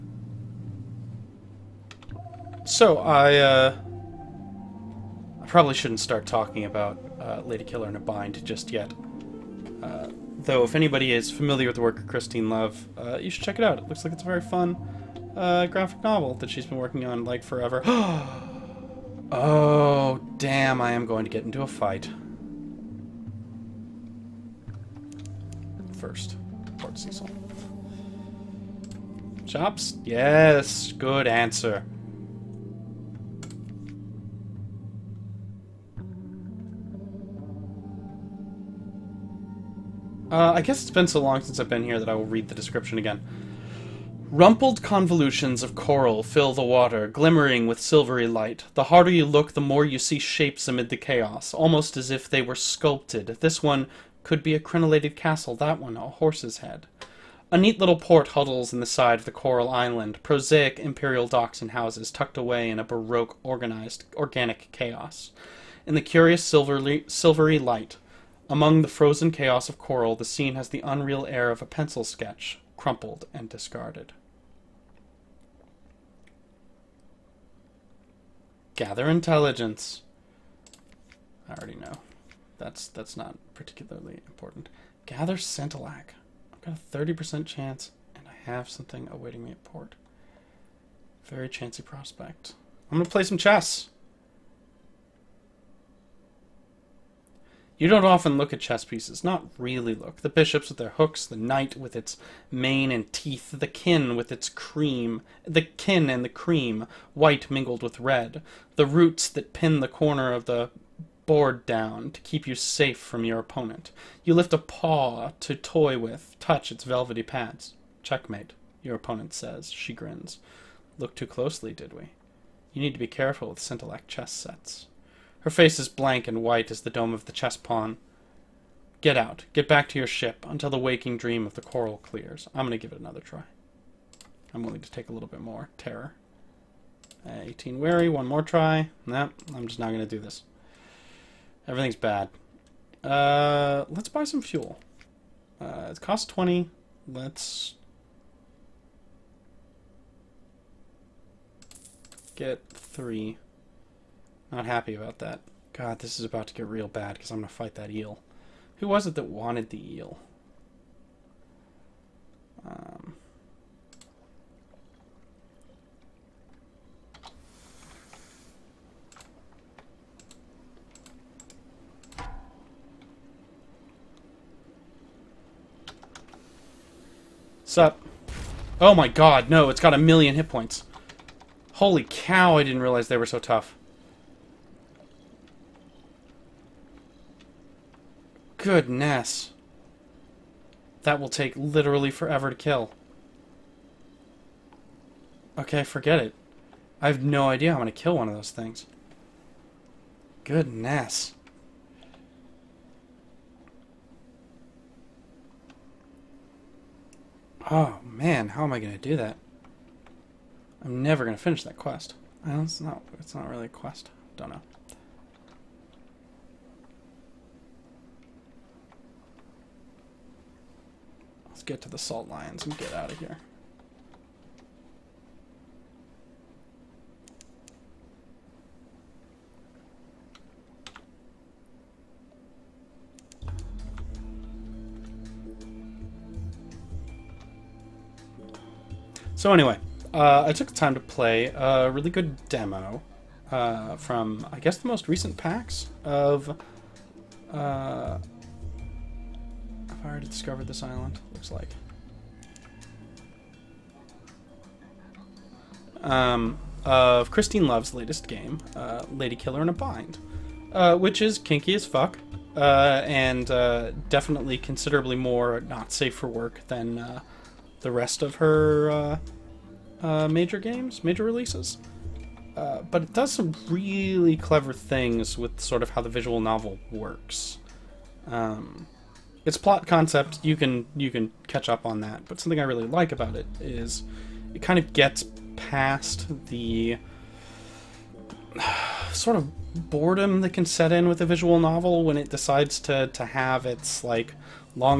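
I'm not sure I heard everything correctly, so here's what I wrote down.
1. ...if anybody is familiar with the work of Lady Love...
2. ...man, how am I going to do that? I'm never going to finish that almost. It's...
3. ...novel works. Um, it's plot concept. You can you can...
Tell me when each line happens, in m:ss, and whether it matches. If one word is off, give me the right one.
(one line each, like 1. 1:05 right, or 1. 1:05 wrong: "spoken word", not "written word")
1. 0:10 wrong: "Christine", not "Lady"
2. 3:28 wrong: "quest", not "almost"
3. 4:36 right.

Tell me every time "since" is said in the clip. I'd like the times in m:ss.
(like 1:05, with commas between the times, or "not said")
0:41.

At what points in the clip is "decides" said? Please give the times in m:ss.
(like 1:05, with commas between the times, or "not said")
4:52.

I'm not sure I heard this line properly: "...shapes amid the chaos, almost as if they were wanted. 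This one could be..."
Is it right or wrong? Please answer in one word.
wrong.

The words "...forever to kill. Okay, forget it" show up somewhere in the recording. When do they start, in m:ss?
3:12.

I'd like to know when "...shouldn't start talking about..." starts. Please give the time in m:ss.
0:05.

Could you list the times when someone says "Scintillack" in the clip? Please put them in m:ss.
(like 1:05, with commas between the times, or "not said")
1:25, 2:03.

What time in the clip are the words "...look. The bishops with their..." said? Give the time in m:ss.
1:39.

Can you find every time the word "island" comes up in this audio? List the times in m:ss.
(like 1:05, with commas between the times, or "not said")
0:59, 4:10.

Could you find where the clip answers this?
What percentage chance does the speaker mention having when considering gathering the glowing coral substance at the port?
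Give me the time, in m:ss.
1:26.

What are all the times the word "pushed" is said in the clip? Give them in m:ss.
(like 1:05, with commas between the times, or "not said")
not said.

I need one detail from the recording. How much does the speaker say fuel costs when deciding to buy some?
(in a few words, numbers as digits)
20.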